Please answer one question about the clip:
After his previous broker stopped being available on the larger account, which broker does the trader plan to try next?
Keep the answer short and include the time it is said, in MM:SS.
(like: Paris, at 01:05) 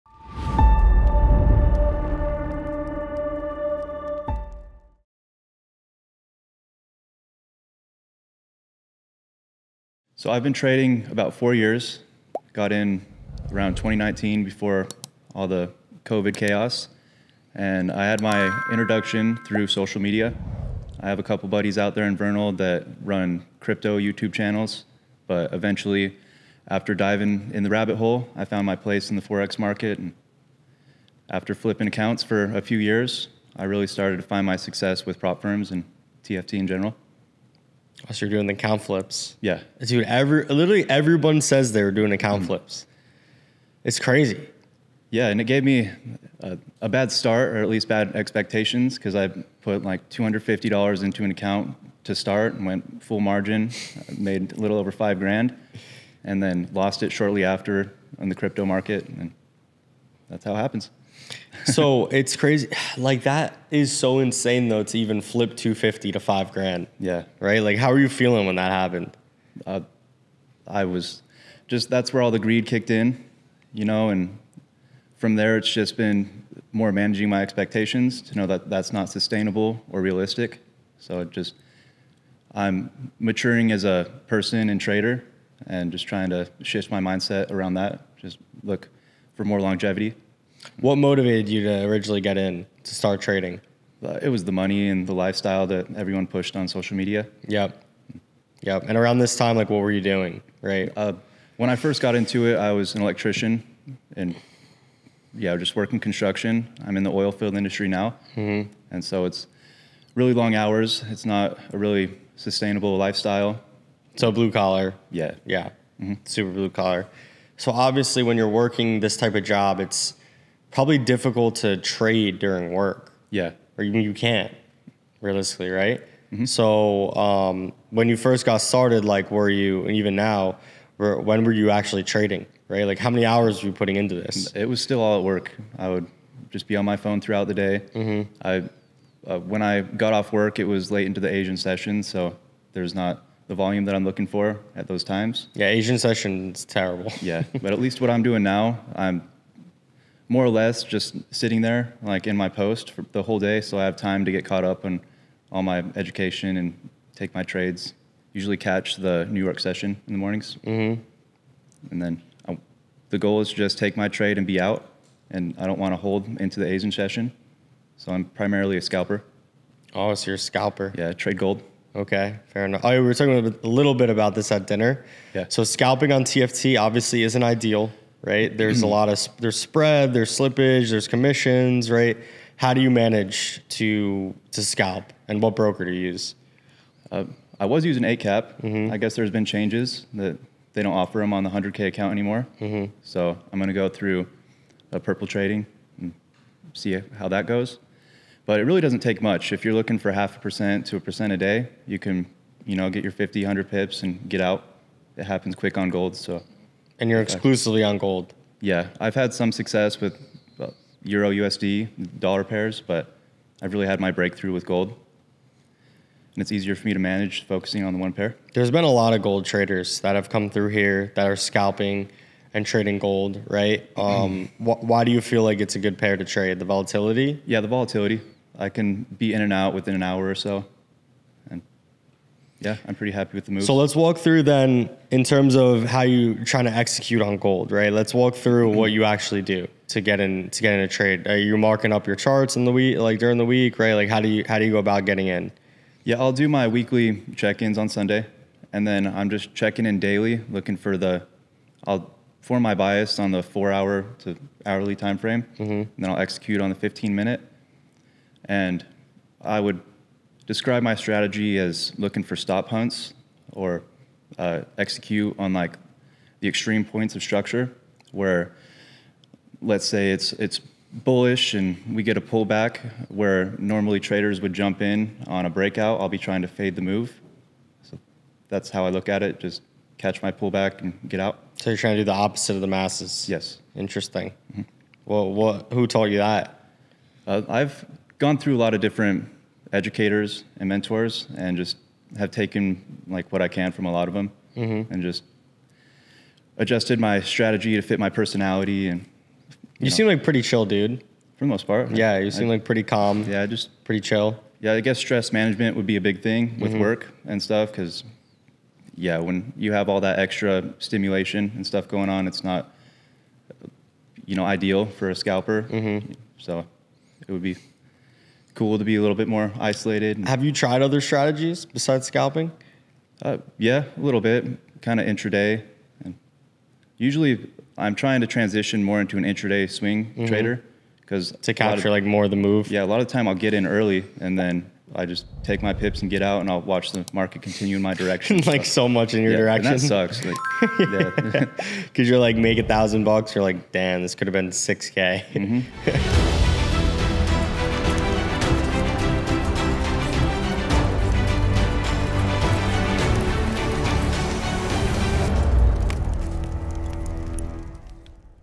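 Purple Trading, at 03:14.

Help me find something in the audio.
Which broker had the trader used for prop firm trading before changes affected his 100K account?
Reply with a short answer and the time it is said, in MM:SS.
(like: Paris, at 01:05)
Eightcap, at 03:08.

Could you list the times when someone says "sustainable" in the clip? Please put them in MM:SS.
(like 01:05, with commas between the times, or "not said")
01:19, 01:52.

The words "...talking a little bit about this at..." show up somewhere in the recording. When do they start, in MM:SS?
02:53.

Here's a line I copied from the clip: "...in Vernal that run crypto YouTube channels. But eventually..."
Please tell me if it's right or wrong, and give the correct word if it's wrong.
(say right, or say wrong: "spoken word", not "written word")
right.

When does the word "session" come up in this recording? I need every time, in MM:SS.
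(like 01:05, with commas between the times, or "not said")
02:21, 02:25, 02:39, 02:46.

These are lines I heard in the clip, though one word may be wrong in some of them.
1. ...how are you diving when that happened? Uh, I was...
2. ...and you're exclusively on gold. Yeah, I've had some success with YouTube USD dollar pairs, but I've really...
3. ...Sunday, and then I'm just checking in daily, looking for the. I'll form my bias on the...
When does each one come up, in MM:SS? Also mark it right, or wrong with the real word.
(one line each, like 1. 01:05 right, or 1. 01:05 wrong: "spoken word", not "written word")
1. 01:07 wrong: "feeling", not "diving"
2. 03:27 wrong: "Euro", not "YouTube"
3. 04:07 right.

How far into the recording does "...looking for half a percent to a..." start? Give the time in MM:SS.
03:19.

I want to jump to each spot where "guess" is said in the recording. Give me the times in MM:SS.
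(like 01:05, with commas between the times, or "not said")
03:08, 05:04.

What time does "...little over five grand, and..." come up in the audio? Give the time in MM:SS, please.
00:54.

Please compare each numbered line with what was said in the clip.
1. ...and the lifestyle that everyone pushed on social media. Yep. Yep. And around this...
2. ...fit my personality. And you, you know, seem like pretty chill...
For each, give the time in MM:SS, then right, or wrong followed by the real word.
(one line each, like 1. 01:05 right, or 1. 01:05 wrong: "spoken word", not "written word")
1. 01:34 right
2. 04:57 right.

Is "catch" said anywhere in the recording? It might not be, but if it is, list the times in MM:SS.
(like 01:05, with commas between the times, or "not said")
02:38, 04:39.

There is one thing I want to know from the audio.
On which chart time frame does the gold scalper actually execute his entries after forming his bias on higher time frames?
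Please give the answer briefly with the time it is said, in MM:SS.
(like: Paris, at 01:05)
15-minute, at 04:16.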